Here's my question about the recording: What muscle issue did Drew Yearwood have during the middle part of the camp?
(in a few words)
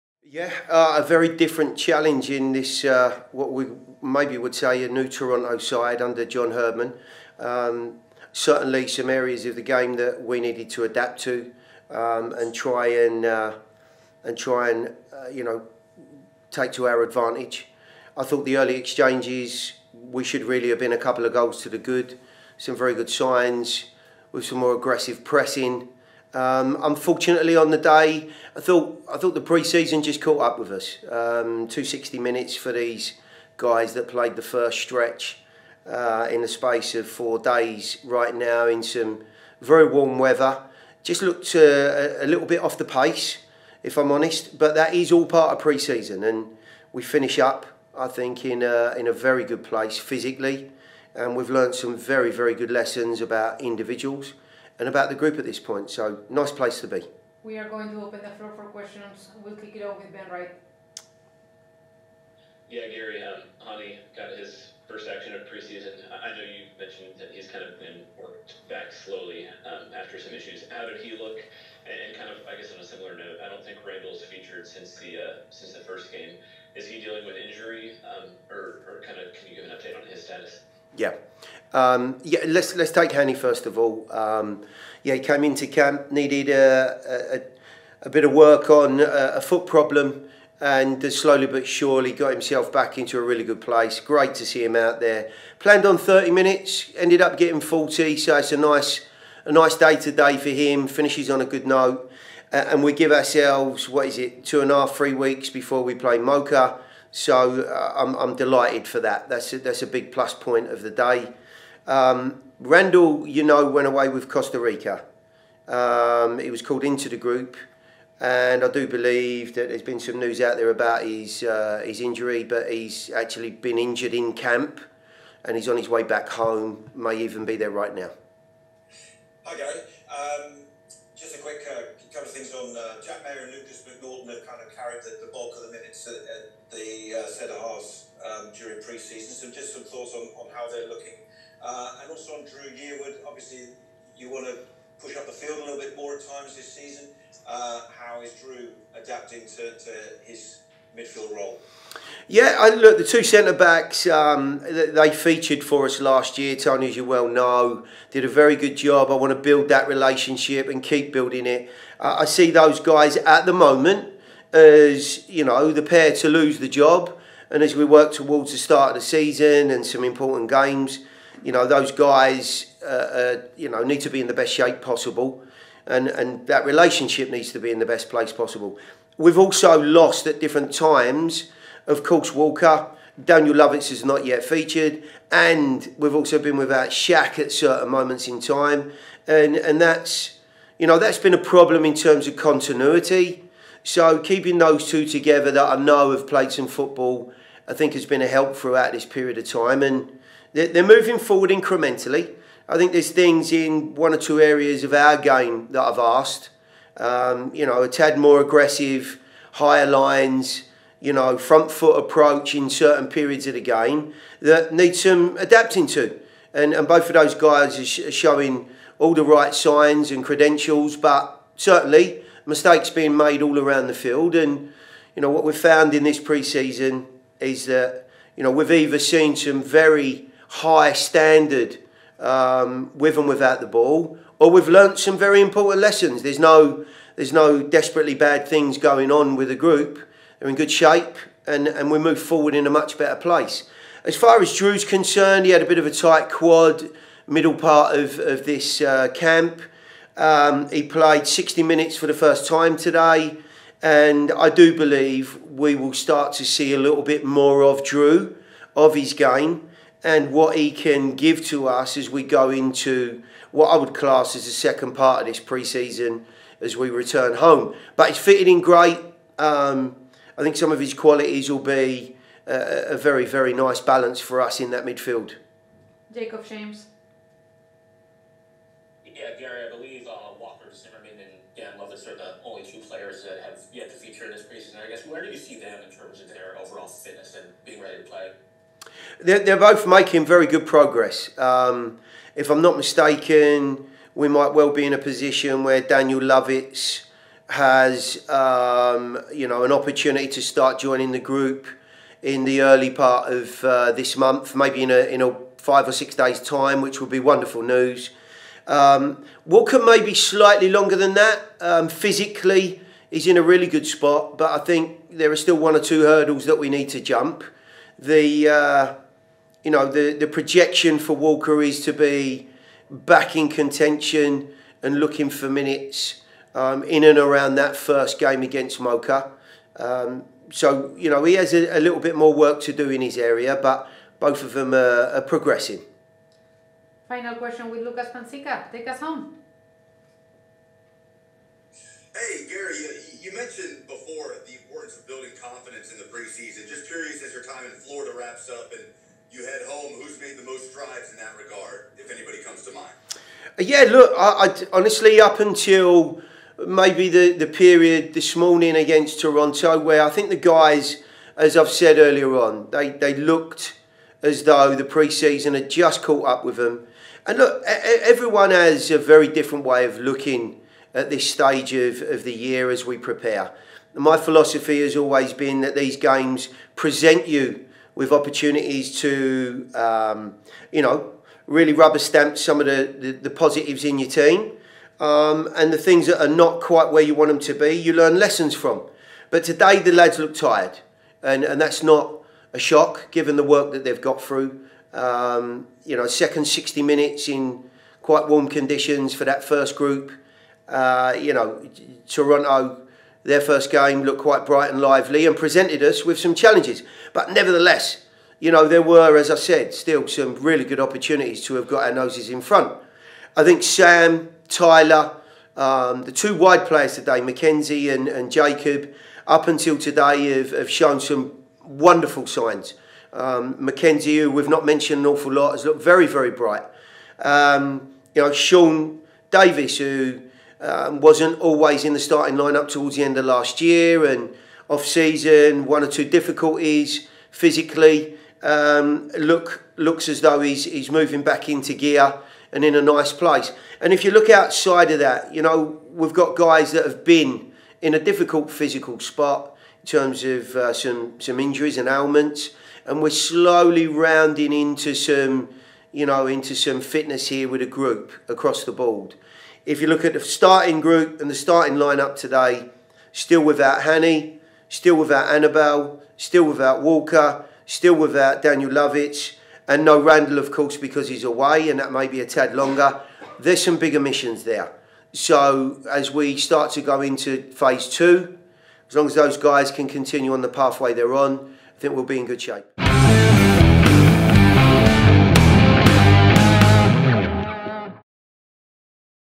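tight quad.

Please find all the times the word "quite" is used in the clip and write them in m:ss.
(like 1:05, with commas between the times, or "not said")
6:26, 6:38, 6:44.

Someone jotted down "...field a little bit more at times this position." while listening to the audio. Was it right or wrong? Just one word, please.
wrong.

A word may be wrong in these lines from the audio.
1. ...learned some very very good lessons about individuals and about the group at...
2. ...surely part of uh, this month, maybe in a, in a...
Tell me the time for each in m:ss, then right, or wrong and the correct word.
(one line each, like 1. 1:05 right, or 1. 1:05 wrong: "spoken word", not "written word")
1. 0:51 right
2. 5:02 wrong: "early", not "surely".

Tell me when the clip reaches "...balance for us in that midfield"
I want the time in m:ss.
4:33.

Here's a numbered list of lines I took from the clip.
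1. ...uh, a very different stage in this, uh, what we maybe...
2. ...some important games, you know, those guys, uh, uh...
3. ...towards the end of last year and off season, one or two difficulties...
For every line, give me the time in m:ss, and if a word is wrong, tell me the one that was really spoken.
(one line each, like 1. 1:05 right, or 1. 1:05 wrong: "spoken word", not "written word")
1. 0:00 wrong: "challenge", not "stage"
2. 2:49 right
3. 7:12 right.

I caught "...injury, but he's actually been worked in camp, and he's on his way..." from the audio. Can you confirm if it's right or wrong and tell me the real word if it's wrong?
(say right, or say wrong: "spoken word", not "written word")
wrong: "injured", not "worked".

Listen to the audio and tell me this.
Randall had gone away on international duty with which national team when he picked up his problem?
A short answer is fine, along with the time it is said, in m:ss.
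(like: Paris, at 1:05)
Costa Rica, at 1:54.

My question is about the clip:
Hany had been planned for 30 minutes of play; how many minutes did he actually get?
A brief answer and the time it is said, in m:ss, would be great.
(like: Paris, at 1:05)
40, at 1:37.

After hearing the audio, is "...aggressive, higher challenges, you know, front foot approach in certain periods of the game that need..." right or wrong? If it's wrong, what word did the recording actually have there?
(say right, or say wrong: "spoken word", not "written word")
wrong: "lines", not "challenges".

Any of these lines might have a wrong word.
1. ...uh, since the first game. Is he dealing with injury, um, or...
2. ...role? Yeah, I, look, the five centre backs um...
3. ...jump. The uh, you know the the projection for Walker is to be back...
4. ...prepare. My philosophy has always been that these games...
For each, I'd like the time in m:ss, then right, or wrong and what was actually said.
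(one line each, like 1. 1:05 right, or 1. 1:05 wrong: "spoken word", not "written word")
1. 1:15 right
2. 2:31 wrong: "two", not "five"
3. 5:17 right
4. 6:12 right.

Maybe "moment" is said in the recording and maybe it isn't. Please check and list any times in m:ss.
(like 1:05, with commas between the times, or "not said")
2:43, 3:07.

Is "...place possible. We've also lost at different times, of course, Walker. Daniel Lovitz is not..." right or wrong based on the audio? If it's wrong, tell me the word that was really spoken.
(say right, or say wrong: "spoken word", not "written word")
right.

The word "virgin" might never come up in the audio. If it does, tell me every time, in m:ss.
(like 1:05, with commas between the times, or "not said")
not said.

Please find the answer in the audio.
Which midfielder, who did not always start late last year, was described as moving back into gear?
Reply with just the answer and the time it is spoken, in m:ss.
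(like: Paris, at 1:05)
Sean Davis, at 7:08.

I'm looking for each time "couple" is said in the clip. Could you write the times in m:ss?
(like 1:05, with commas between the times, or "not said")
0:20, 2:12.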